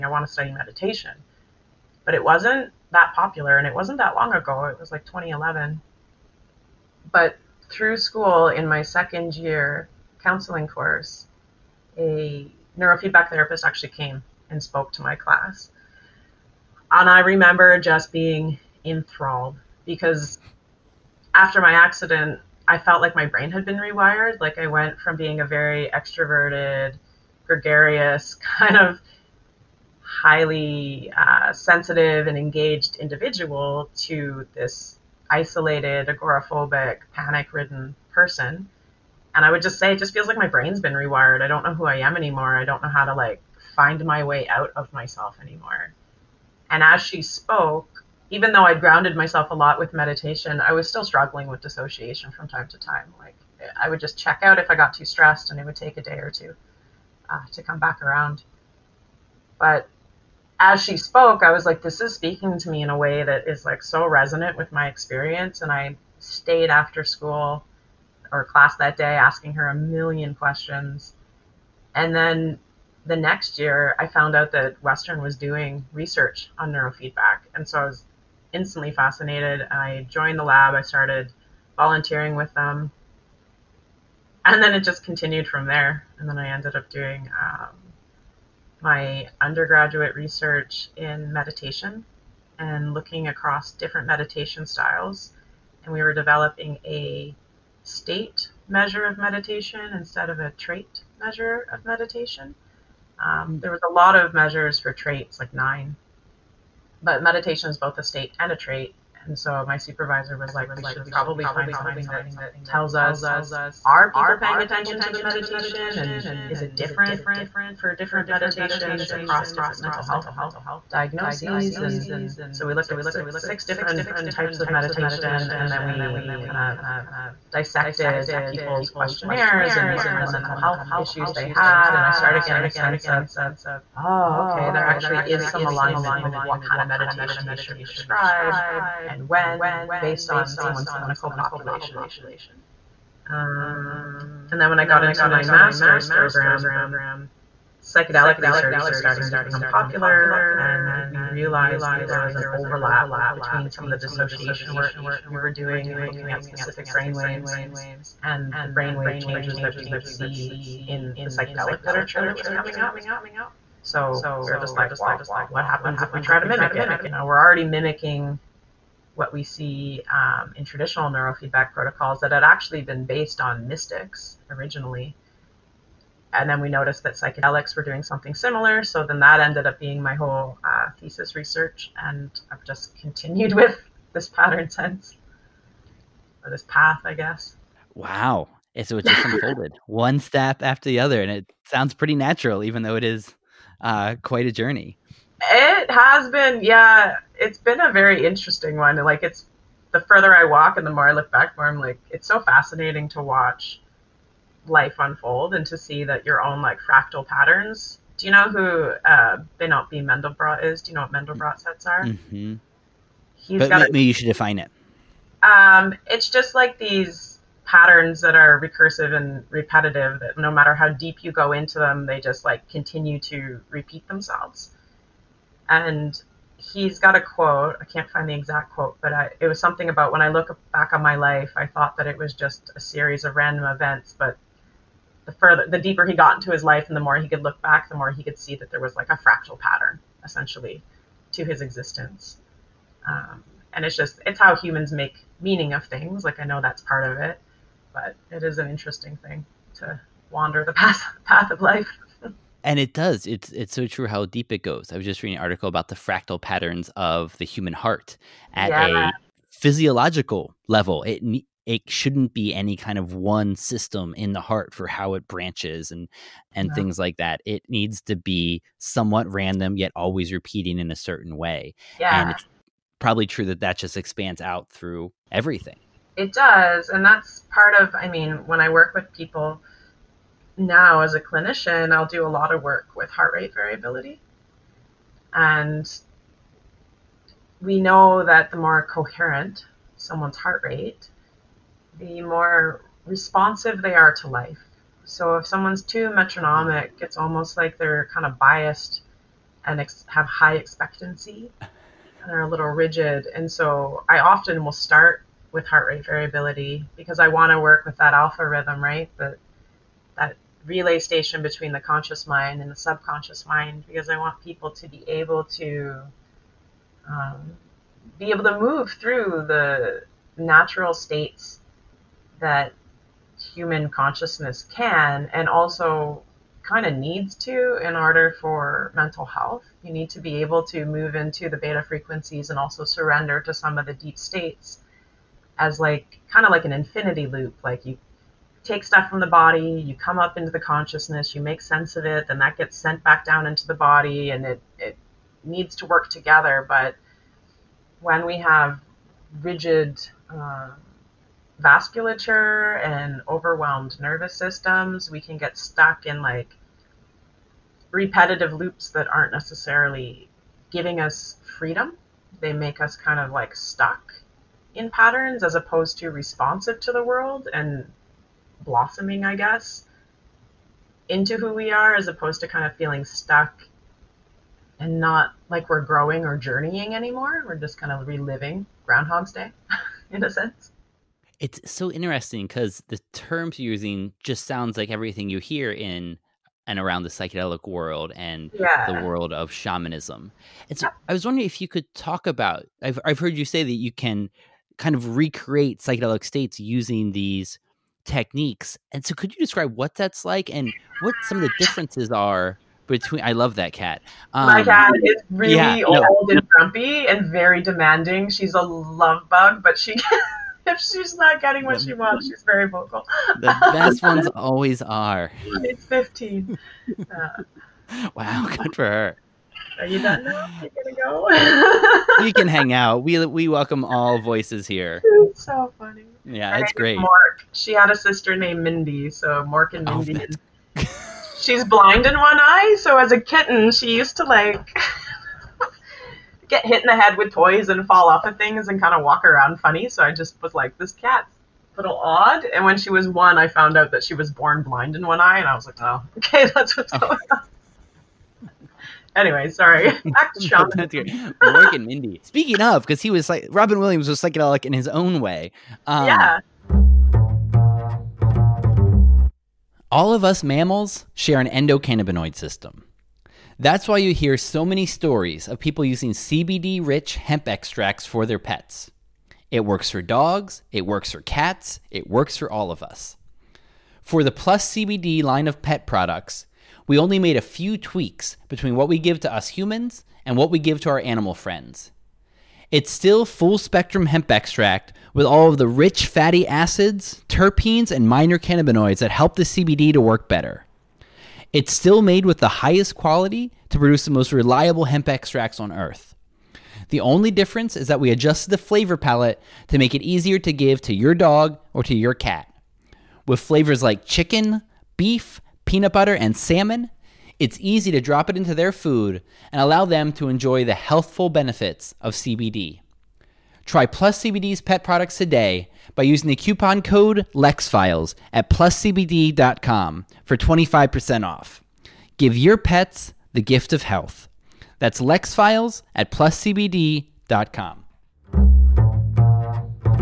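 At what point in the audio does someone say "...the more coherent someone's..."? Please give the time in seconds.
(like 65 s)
288 s.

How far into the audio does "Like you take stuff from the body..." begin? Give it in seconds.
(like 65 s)
337 s.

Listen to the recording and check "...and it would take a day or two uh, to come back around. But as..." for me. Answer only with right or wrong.
right.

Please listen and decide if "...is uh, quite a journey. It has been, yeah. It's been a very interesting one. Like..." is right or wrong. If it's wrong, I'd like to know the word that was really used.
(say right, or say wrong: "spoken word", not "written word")
right.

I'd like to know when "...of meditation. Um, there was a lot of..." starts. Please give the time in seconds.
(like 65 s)
101 s.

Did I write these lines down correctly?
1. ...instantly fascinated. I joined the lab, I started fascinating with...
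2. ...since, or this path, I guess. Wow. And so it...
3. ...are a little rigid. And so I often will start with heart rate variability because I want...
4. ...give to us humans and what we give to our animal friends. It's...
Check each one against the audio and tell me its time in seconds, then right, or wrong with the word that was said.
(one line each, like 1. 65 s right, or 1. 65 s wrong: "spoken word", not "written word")
1. 78 s wrong: "volunteering", not "fascinating"
2. 184 s right
3. 302 s right
4. 478 s right.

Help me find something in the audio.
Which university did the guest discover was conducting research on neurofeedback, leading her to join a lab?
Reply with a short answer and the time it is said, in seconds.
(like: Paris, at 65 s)
Western, at 74 s.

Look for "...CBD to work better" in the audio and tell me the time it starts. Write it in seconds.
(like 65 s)
489 s.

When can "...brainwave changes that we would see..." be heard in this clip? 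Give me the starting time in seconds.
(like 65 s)
158 s.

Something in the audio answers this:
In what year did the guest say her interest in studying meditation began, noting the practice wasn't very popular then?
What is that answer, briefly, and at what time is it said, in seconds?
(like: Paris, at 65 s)
2011, at 5 s.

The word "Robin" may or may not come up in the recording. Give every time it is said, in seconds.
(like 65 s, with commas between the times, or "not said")
453 s.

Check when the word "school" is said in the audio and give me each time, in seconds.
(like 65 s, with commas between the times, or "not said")
7 s, 67 s.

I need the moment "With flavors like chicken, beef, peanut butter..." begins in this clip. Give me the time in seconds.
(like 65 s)
503 s.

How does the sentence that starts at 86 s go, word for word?
And then I ended up doing um, my undergraduate research in meditation and looking across different meditation styles.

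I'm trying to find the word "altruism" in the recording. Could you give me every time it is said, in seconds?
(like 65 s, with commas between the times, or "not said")
not said.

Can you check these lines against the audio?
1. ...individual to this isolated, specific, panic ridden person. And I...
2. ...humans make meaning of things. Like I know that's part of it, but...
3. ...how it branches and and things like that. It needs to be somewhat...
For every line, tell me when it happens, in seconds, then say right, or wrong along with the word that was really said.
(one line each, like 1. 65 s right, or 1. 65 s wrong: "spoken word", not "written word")
1. 32 s wrong: "agoraphobic", not "specific"
2. 244 s right
3. 264 s right.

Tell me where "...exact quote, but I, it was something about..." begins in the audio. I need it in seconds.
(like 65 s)
228 s.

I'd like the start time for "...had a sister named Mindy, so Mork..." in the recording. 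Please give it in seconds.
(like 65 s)
427 s.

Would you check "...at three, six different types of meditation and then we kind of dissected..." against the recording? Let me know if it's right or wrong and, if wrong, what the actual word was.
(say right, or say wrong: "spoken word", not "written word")
wrong: "six", not "three".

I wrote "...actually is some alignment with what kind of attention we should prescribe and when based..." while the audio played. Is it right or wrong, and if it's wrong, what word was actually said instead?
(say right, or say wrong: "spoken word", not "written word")
wrong: "meditation", not "attention".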